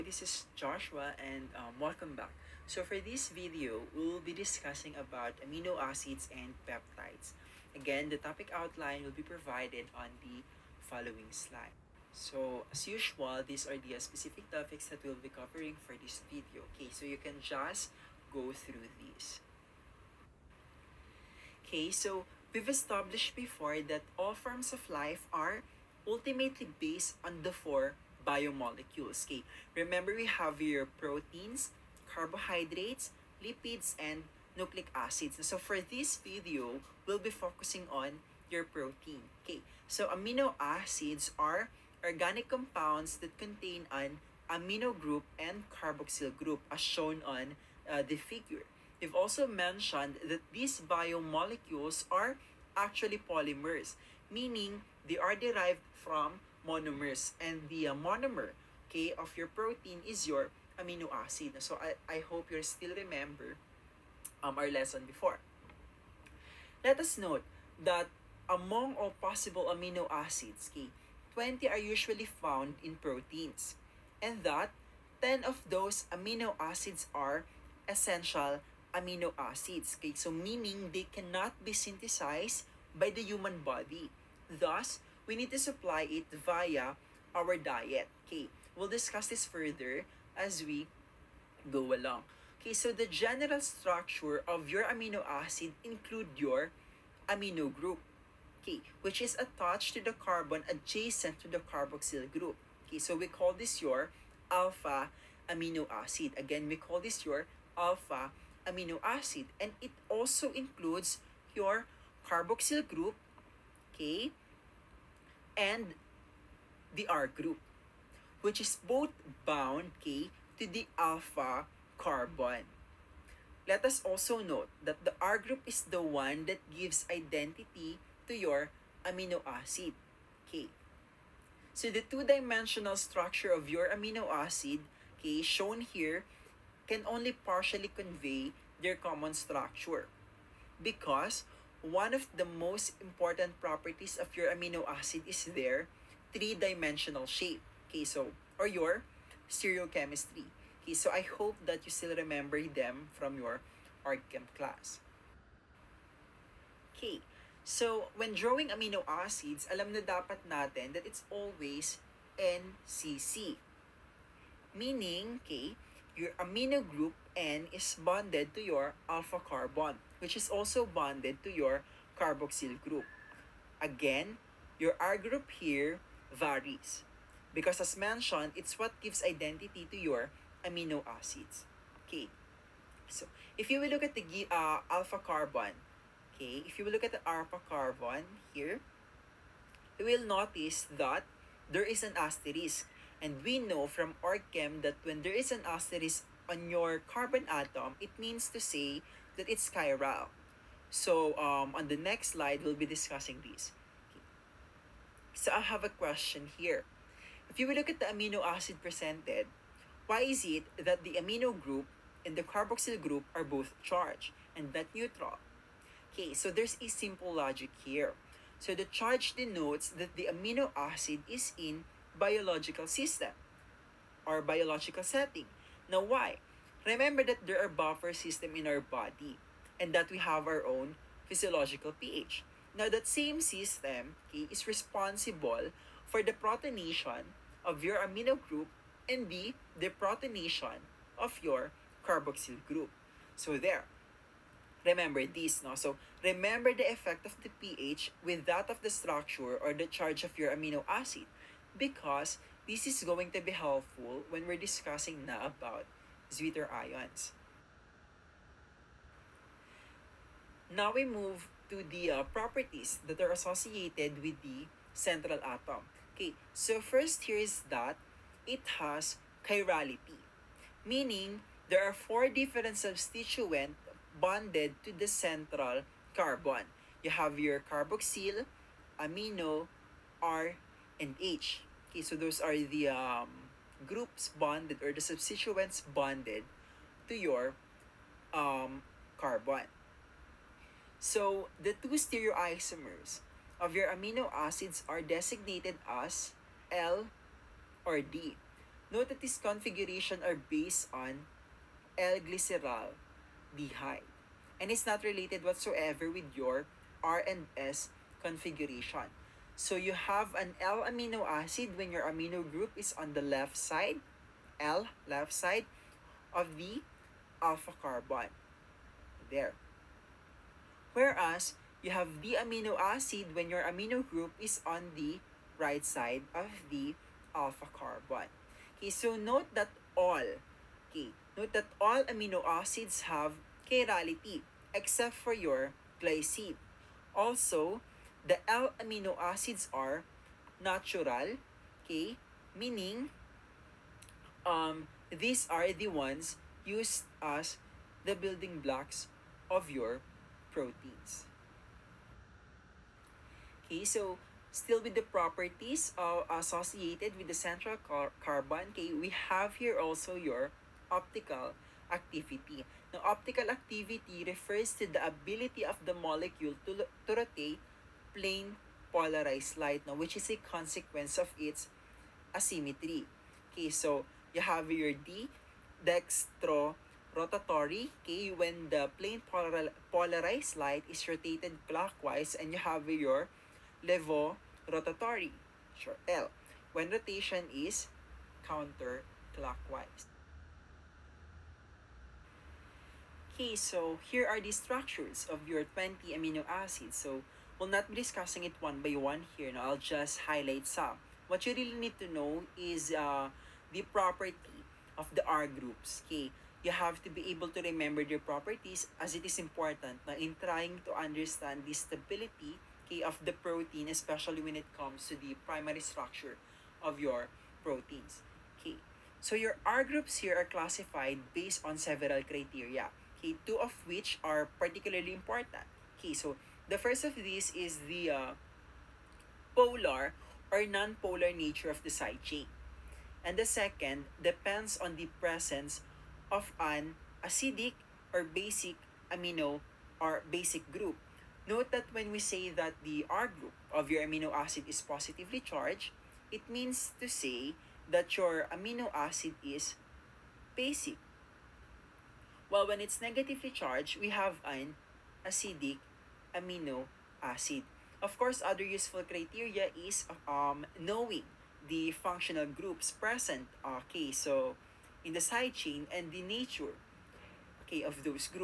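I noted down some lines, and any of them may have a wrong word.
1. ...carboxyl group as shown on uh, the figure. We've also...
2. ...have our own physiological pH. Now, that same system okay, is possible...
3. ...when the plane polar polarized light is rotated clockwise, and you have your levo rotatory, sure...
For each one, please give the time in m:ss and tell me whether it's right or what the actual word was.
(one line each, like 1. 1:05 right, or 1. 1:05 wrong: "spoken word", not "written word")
1. 0:45 right
2. 3:50 wrong: "responsible", not "possible"
3. 6:18 right.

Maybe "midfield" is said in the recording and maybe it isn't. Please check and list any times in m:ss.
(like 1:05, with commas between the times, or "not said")
not said.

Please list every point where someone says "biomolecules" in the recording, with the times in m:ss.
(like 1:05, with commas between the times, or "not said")
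0:28, 0:50.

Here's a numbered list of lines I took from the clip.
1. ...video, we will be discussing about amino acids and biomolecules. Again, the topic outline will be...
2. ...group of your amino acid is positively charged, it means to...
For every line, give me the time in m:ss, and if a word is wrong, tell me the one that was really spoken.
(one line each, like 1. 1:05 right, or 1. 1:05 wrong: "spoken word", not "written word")
1. 0:03 wrong: "peptides", not "biomolecules"
2. 7:23 right.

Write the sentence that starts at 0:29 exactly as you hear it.
Okay, remember we have your proteins, carbohydrates, lipids, and nucleic acids.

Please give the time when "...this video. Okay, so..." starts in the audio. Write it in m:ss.
0:15.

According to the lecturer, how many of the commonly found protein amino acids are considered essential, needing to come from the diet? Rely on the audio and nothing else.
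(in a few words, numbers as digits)
10.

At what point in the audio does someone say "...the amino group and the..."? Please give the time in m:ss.
3:31.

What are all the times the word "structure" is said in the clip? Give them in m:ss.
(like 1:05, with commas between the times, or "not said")
1:33, 2:12, 2:19, 4:08, 6:34, 6:55.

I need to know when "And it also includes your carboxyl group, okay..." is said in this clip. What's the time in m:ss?
1:49.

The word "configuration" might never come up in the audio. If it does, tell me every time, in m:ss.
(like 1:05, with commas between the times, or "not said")
4:59, 5:08.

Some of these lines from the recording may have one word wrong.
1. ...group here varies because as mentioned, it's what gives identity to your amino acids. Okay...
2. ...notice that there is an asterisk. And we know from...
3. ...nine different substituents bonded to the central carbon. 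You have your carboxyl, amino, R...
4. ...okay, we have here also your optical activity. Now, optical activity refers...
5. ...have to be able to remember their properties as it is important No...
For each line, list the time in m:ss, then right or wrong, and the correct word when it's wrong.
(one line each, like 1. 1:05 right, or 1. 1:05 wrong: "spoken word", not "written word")
1. 2:55 right
2. 3:10 right
3. 4:31 wrong: "four", not "nine"
4. 5:58 right
5. 6:46 right.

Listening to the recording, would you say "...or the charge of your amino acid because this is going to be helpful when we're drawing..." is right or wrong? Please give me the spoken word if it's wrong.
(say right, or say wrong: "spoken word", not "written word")
wrong: "discussing", not "drawing".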